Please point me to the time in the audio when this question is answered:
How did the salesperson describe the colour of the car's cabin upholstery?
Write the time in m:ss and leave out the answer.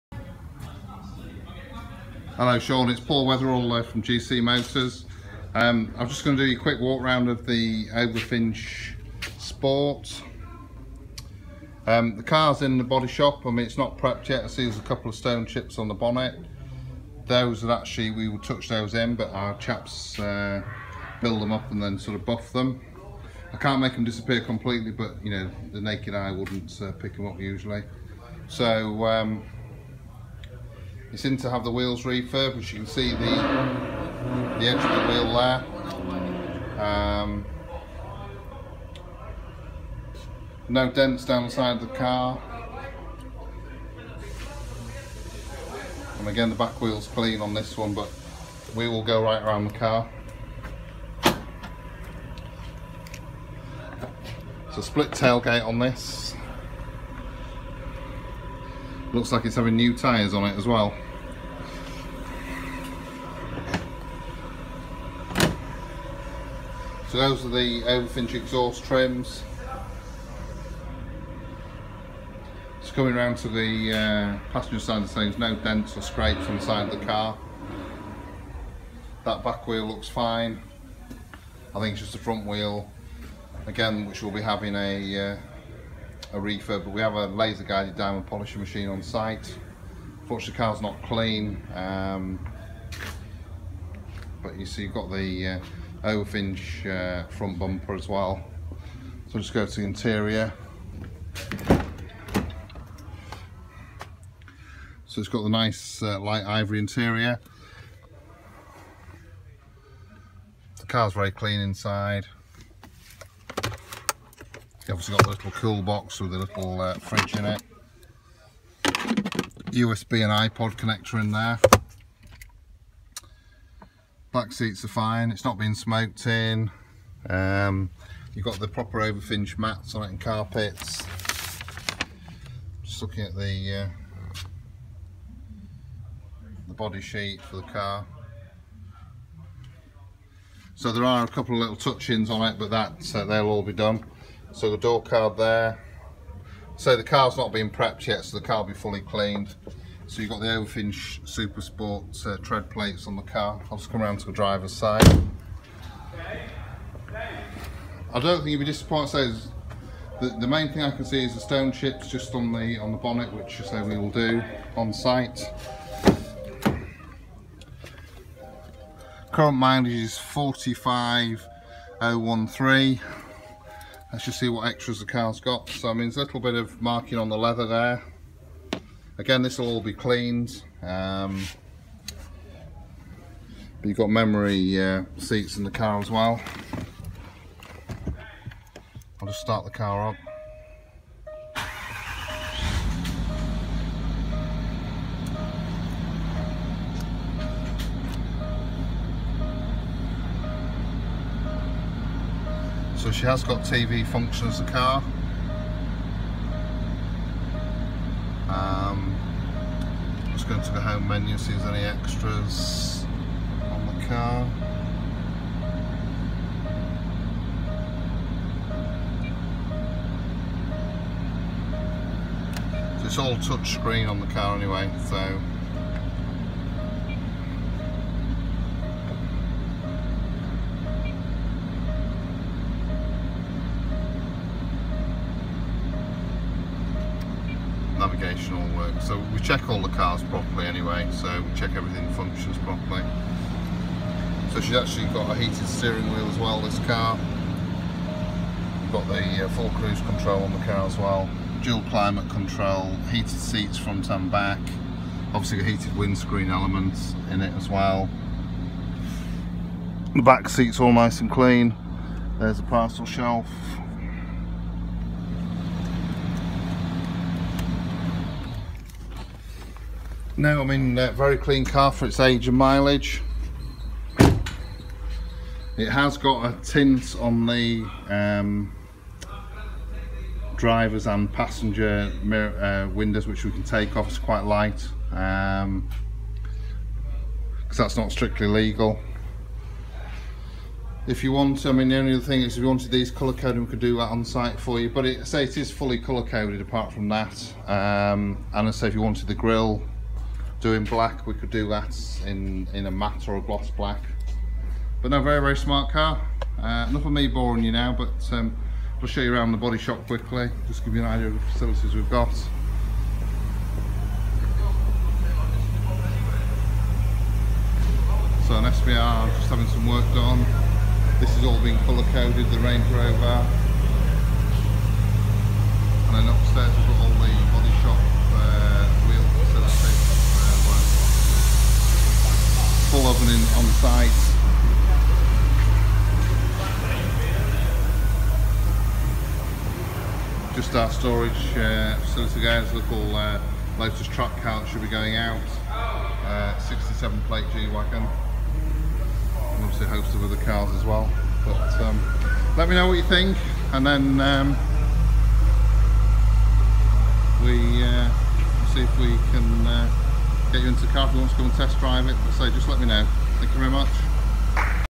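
1:46.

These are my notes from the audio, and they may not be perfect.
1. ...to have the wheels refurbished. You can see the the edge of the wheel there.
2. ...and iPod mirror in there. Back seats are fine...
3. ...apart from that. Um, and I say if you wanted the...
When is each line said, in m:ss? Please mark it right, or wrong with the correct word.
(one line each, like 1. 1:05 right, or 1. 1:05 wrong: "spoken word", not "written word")
1. 0:31 right
2. 2:00 wrong: "connector", not "mirror"
3. 4:56 right.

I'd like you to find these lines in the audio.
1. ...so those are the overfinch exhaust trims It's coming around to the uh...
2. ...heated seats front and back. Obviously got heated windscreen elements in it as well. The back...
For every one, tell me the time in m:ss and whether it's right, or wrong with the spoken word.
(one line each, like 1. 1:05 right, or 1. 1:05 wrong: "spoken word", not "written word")
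1. 1:07 right
2. 4:13 right.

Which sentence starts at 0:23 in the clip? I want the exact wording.
I can't make them disappear completely, but you know, the naked eye wouldn't uh, pick them up usually.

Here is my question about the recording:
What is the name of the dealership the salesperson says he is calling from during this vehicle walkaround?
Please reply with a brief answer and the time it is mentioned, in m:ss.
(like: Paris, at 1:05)
GC Motors, at 0:04.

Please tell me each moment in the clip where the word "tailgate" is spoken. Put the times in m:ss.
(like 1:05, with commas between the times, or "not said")
0:55.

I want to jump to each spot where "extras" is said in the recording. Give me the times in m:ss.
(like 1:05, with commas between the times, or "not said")
2:54, 3:31.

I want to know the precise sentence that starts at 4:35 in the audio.
It has got a tint on the um, drivers and passenger mirror, uh, windows, which we can take off.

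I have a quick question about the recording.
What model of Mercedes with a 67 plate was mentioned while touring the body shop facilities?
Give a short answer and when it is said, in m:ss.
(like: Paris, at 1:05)
G-Wagon, at 5:47.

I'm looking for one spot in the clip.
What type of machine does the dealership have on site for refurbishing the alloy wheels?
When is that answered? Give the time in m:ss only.
1:27.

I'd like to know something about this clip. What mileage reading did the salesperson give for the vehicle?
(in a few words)
45013.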